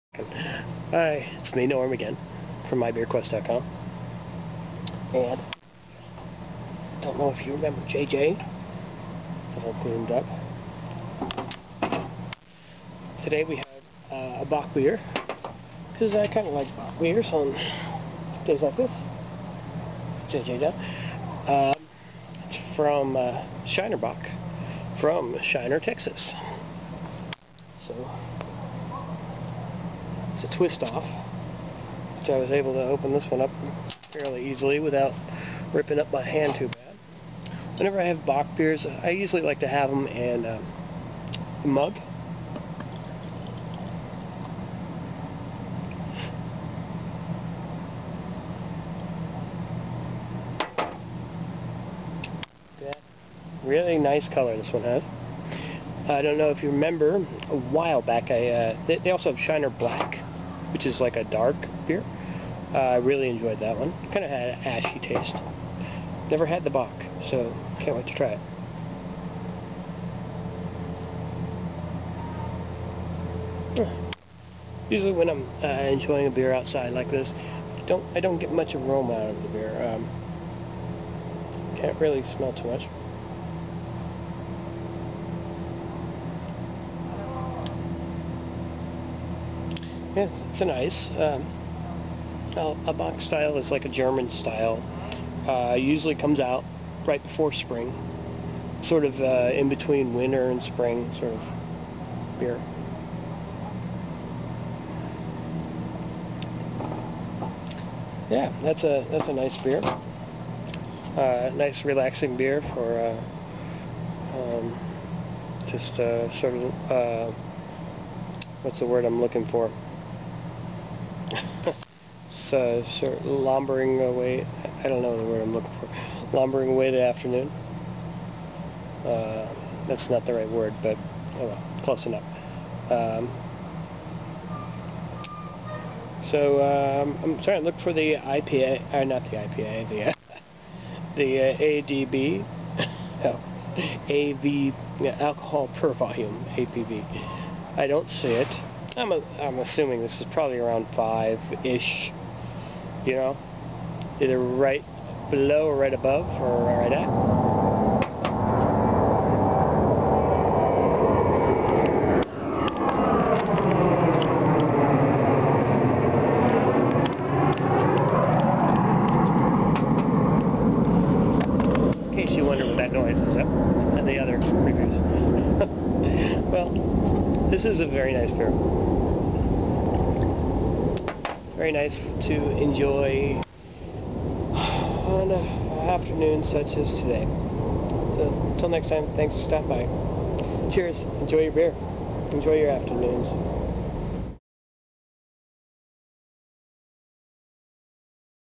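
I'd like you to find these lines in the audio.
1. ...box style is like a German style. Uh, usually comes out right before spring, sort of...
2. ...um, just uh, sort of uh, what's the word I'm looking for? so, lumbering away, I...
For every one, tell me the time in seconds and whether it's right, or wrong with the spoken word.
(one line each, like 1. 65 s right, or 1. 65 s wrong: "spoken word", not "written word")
1. 92 s right
2. 114 s right.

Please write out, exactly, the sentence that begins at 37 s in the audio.
Whenever I have bock beers, I usually like to have them in a um, mug.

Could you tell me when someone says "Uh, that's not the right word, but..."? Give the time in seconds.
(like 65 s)
129 s.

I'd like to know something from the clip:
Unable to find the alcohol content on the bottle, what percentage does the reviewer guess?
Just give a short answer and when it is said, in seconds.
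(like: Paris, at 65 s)
5, at 150 s.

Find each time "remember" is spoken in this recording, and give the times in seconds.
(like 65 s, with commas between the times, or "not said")
7 s, 56 s.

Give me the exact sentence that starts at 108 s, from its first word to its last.
Yeah, that's a that's a nice beer.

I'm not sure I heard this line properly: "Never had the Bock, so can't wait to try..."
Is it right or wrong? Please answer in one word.
right.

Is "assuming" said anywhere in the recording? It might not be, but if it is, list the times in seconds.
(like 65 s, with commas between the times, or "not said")
149 s.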